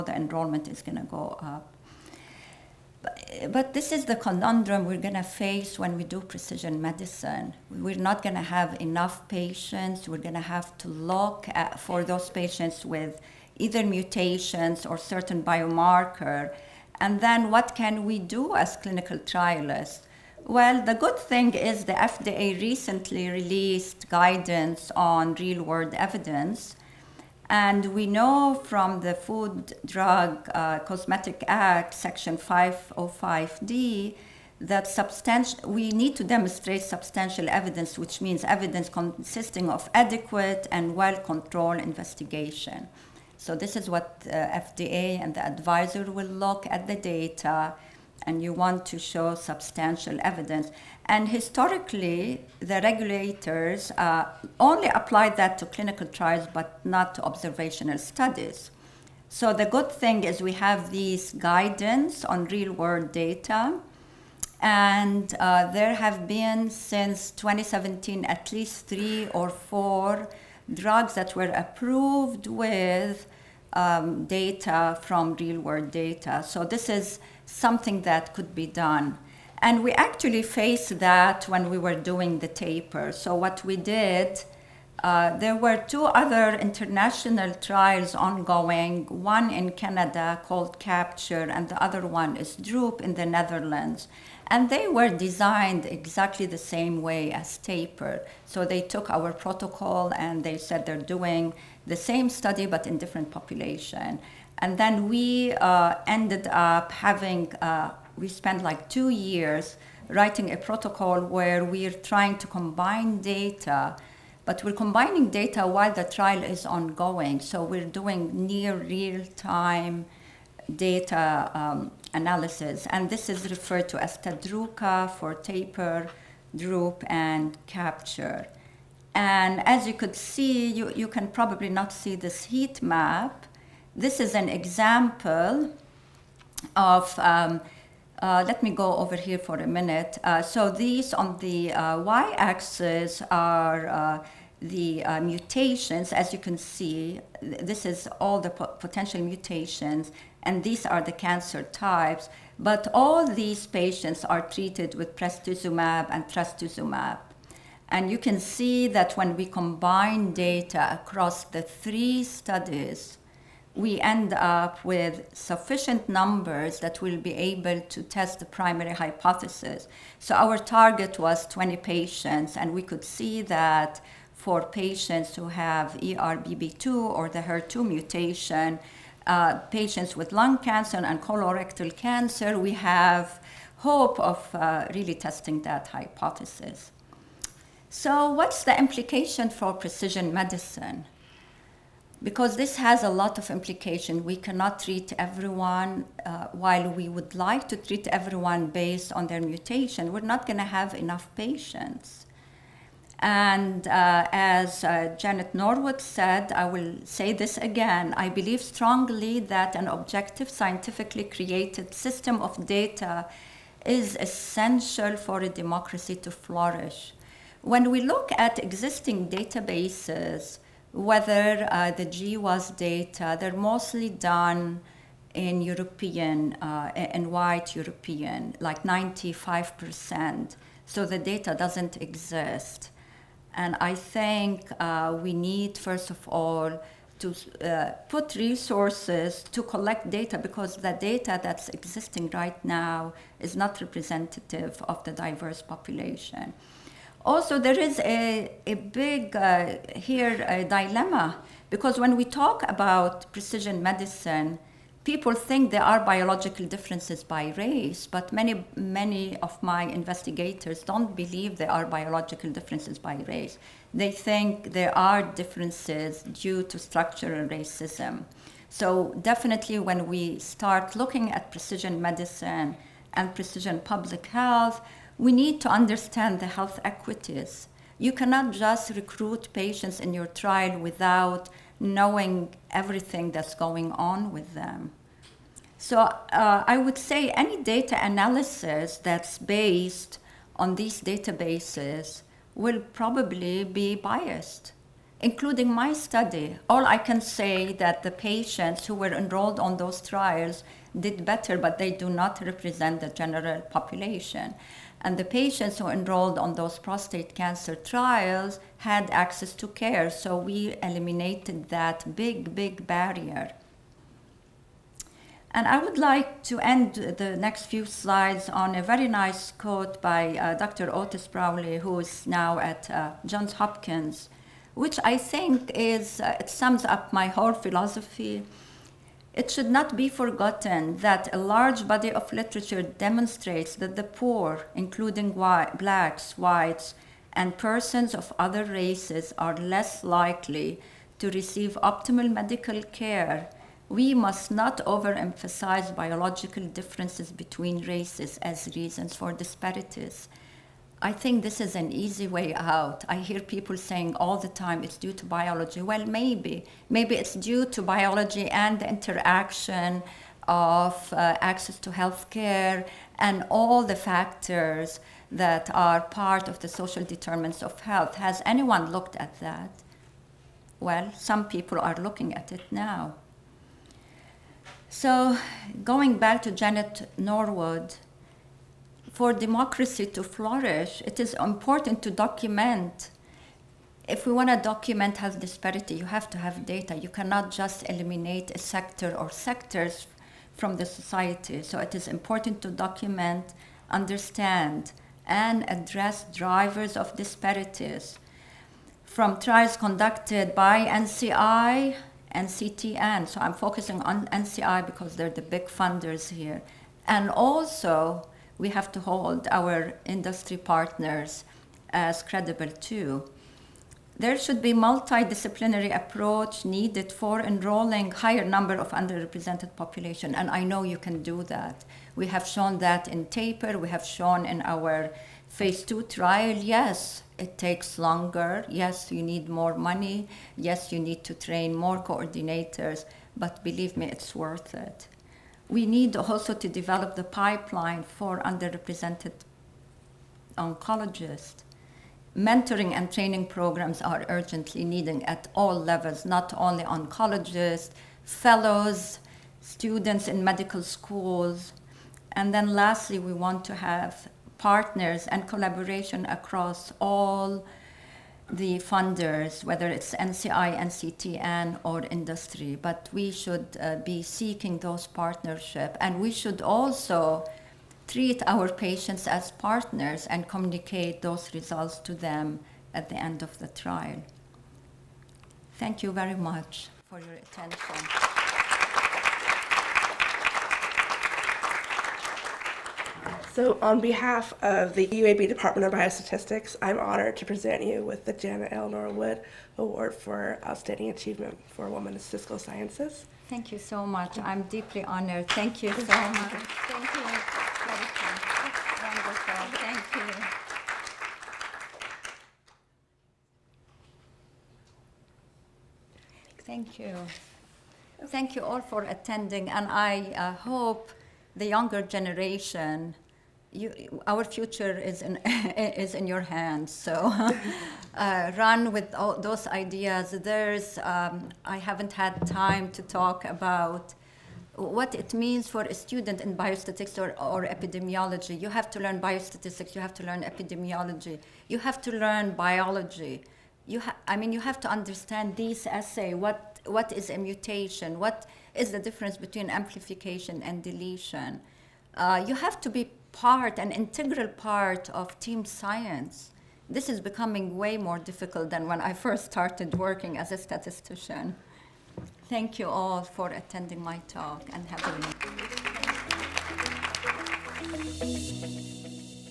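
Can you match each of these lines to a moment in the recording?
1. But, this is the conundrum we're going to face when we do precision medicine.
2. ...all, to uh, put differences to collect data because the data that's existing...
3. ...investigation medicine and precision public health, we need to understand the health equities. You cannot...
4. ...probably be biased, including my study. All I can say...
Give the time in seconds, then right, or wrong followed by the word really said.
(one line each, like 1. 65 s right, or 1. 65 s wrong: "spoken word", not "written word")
1. 3 s right
2. 236 s wrong: "resources", not "differences"
3. 271 s wrong: "precision", not "investigation"
4. 292 s right.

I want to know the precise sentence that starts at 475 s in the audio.
Thank you very much for your attention.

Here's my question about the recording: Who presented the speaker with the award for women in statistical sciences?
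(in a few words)
UAB Department of Biostatistics.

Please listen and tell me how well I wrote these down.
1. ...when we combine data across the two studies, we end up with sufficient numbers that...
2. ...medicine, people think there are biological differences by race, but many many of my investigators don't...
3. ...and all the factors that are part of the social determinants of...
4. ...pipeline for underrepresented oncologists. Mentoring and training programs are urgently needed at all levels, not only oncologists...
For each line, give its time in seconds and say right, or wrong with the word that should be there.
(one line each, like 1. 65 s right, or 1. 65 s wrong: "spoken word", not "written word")
1. 159 s wrong: "three", not "two"
2. 253 s right
3. 363 s right
4. 437 s right.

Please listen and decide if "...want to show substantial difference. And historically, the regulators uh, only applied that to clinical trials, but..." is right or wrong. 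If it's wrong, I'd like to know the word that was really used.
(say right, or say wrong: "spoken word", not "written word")
wrong: "evidence", not "difference".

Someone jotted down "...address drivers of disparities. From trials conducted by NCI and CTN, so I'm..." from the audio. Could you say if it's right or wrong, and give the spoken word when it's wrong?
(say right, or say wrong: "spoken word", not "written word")
right.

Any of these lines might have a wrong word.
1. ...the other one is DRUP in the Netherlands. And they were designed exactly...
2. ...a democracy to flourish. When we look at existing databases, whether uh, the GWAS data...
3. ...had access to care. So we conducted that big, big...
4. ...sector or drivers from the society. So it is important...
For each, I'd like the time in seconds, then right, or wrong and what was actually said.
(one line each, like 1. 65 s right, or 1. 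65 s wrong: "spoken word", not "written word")
1. 91 s right
2. 215 s right
3. 308 s wrong: "eliminated", not "conducted"
4. 388 s wrong: "sectors", not "drivers".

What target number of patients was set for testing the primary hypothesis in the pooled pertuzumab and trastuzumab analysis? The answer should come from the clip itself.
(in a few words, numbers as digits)
20.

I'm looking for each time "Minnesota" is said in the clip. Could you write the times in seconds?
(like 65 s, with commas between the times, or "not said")
not said.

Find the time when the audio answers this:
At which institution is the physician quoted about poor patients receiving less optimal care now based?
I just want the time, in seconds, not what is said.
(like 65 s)
323 s.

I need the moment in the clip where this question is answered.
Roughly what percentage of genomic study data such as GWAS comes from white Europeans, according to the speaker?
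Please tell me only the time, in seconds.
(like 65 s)
228 s.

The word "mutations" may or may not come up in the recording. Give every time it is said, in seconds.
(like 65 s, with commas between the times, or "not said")
13 s, 145 s, 149 s, 177 s, 199 s, 537 s.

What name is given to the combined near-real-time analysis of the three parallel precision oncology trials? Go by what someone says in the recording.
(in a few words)
Tadruka.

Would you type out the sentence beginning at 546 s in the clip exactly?
This is becoming way more difficult than when I first started working as a statistician.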